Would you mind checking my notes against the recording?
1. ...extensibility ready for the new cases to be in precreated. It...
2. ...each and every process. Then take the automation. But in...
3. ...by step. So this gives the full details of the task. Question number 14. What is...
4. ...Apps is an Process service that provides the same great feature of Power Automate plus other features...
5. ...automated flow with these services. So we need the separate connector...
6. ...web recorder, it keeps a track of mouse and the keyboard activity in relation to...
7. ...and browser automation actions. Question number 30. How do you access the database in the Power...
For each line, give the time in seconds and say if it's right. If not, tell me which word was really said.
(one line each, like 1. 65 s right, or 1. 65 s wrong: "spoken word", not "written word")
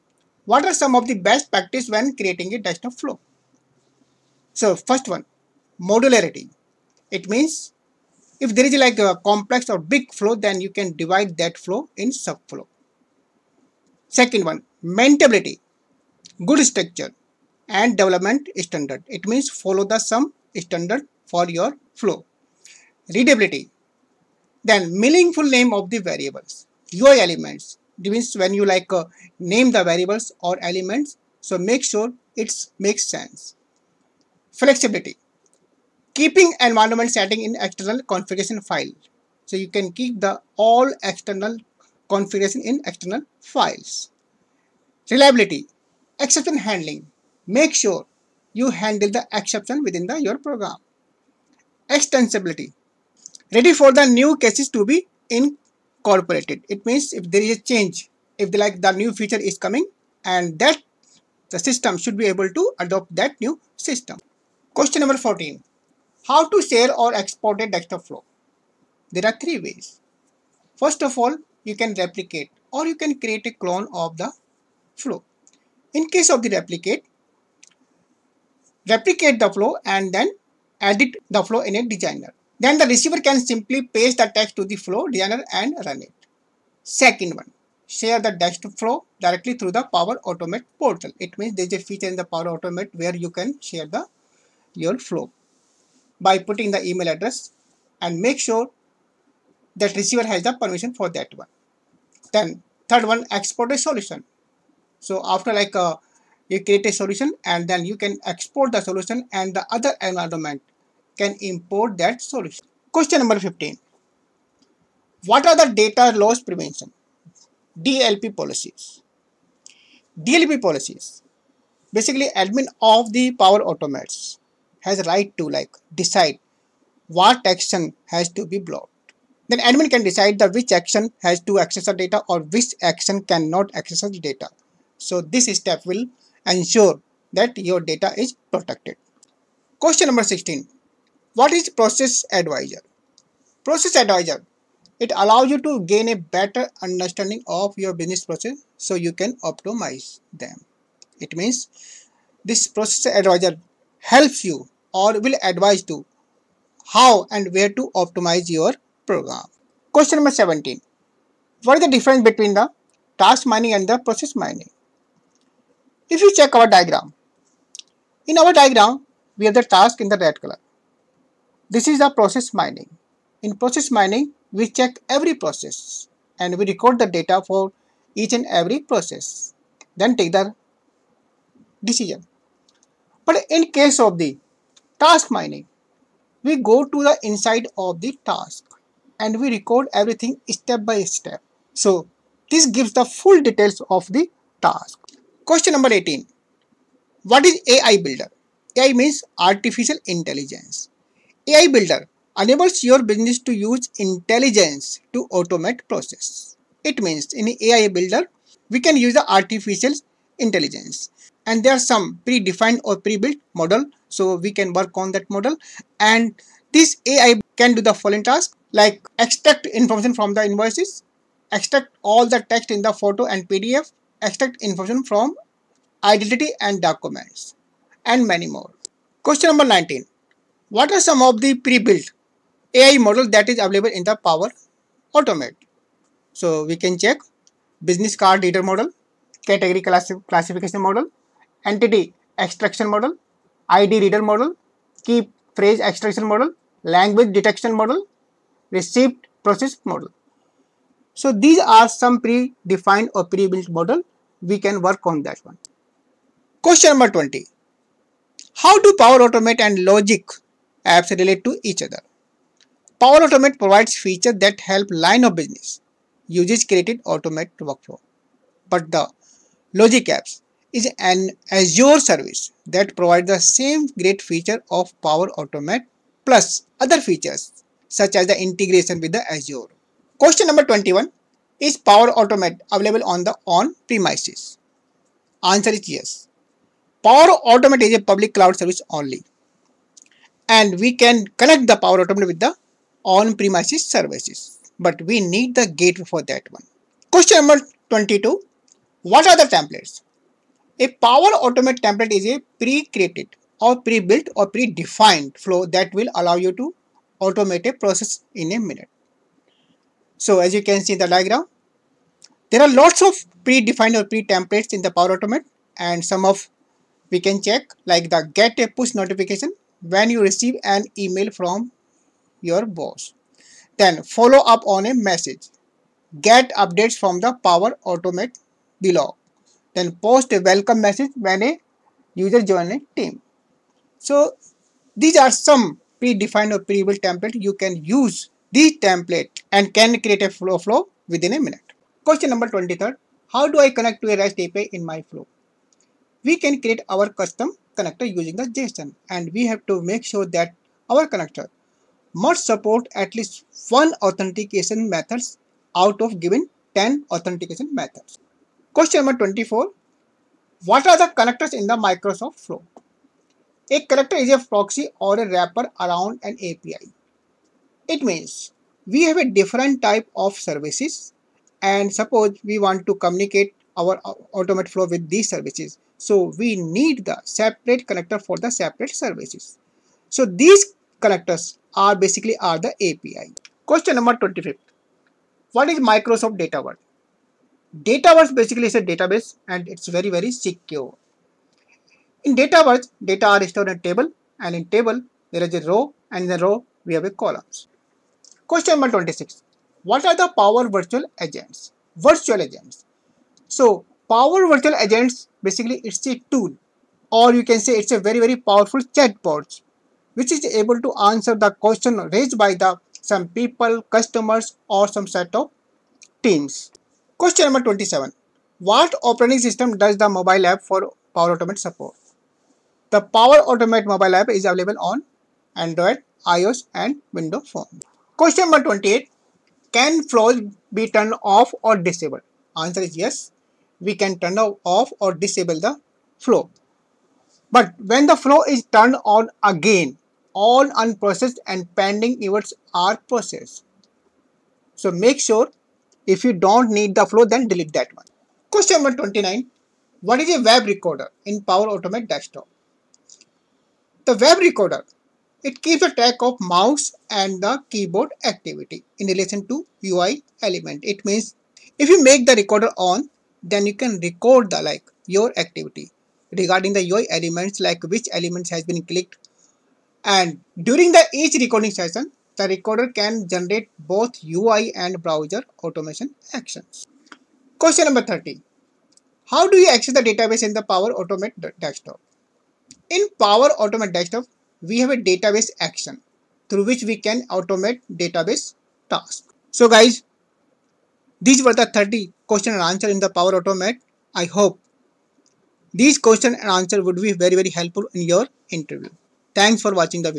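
1. 51 s wrong: "incorporated", not "precreated"
2. 178 s wrong: "decision", not "automation"
3. 190 s wrong: "18", not "14"
4. 270 s wrong: "Azure", not "Process"
5. 374 s right
6. 454 s right
7. 474 s right.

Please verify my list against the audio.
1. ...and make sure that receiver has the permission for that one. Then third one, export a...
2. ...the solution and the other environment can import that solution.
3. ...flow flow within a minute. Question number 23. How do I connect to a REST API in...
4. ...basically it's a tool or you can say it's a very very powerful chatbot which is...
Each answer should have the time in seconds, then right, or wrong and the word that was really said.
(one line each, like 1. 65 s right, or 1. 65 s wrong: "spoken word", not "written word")
1. 98 s right
2. 108 s right
3. 340 s right
4. 405 s right.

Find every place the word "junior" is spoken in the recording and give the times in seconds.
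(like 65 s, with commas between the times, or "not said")
not said.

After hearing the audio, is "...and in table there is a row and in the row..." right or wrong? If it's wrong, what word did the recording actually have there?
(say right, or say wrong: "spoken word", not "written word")
right.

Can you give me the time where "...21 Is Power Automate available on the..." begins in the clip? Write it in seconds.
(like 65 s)
280 s.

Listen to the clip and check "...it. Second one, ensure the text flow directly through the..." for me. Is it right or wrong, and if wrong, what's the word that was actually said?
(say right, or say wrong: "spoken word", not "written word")
wrong: "share", not "ensure".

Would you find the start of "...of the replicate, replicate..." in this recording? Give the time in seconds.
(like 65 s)
76 s.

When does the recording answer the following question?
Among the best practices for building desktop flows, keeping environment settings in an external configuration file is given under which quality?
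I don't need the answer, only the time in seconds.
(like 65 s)
34 s.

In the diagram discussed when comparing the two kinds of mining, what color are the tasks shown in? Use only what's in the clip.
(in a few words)
Red.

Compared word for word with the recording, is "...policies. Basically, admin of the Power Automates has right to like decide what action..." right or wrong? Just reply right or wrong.
right.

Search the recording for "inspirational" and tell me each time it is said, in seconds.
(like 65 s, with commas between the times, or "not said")
not said.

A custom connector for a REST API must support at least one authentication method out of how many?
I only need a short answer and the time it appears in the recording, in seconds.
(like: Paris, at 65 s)
10, at 356 s.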